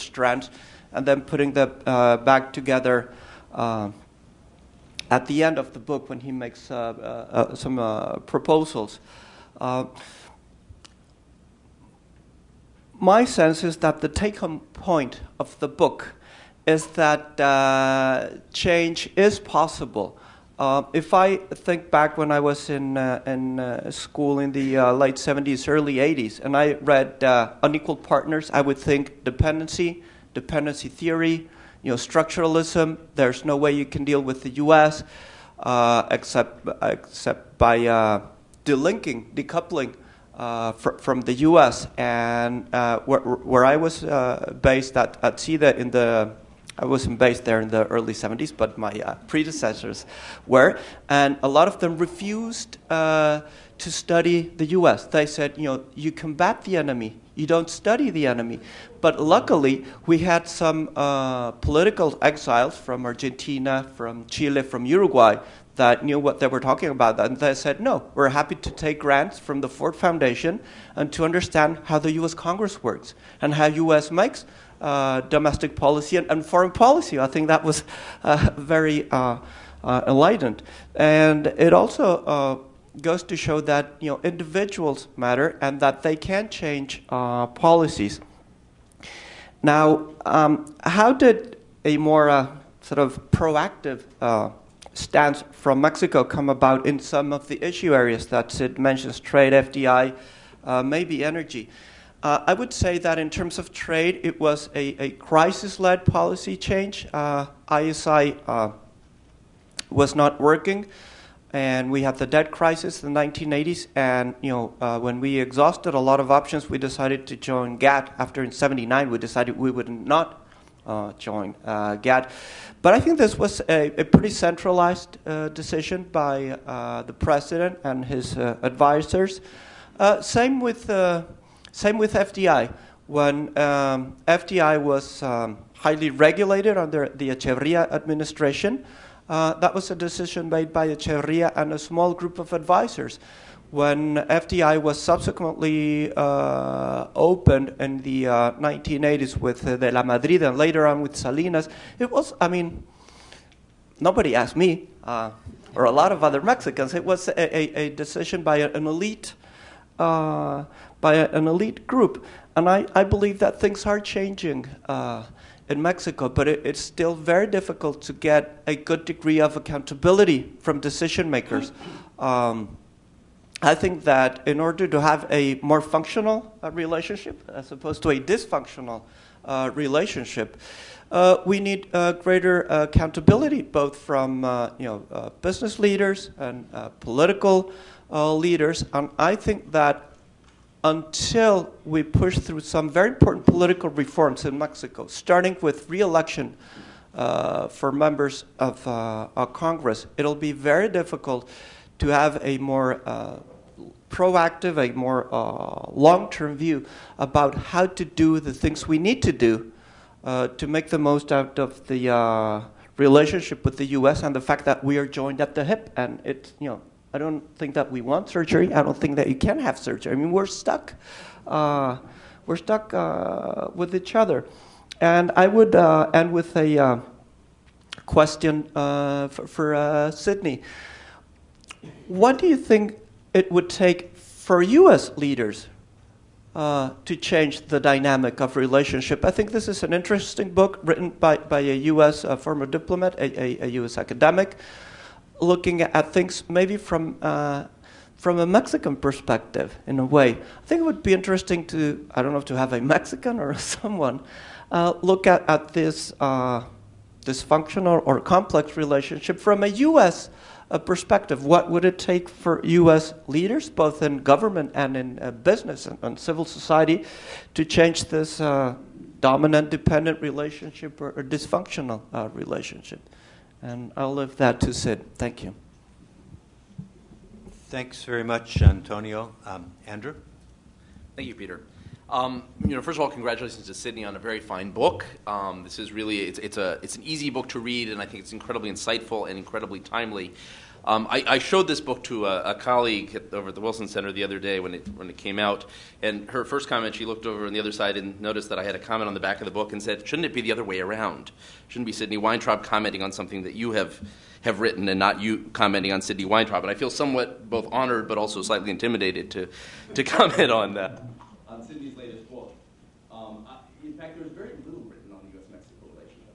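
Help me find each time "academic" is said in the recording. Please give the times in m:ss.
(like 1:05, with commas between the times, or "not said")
4:03.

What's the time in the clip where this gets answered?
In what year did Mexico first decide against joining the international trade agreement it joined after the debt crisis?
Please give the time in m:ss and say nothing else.
1:58.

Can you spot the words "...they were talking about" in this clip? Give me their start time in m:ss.
1:06.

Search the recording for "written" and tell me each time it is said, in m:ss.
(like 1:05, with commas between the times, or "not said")
4:00, 5:04.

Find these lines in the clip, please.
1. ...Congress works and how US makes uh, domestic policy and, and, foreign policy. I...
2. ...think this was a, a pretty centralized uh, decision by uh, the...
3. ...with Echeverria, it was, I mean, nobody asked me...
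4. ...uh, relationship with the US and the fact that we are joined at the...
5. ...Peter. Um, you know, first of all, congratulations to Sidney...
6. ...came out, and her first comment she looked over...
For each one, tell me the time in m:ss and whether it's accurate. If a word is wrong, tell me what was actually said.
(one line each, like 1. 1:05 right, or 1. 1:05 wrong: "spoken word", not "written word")
1. 1:12 right
2. 2:02 right
3. 2:31 wrong: "Salinas", not "Echeverria"
4. 3:32 right
5. 4:41 right
6. 4:55 right.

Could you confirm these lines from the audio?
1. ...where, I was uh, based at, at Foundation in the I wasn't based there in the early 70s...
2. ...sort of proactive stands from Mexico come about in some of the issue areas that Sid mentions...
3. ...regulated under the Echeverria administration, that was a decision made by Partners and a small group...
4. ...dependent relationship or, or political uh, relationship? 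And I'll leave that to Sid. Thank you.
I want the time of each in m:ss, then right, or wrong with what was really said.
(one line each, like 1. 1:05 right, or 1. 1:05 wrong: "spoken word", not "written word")
1. 0:43 wrong: "CIDE", not "Foundation"
2. 1:32 right
3. 2:16 wrong: "Echeverria", not "Partners"
4. 4:29 wrong: "dysfunctional", not "political".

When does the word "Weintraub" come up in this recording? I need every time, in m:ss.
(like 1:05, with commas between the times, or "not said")
5:02, 5:06.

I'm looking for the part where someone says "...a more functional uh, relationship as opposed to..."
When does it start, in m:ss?
2:55.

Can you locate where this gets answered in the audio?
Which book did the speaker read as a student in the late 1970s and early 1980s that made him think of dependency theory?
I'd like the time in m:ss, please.
0:27.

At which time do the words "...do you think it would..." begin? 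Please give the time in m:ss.
3:52.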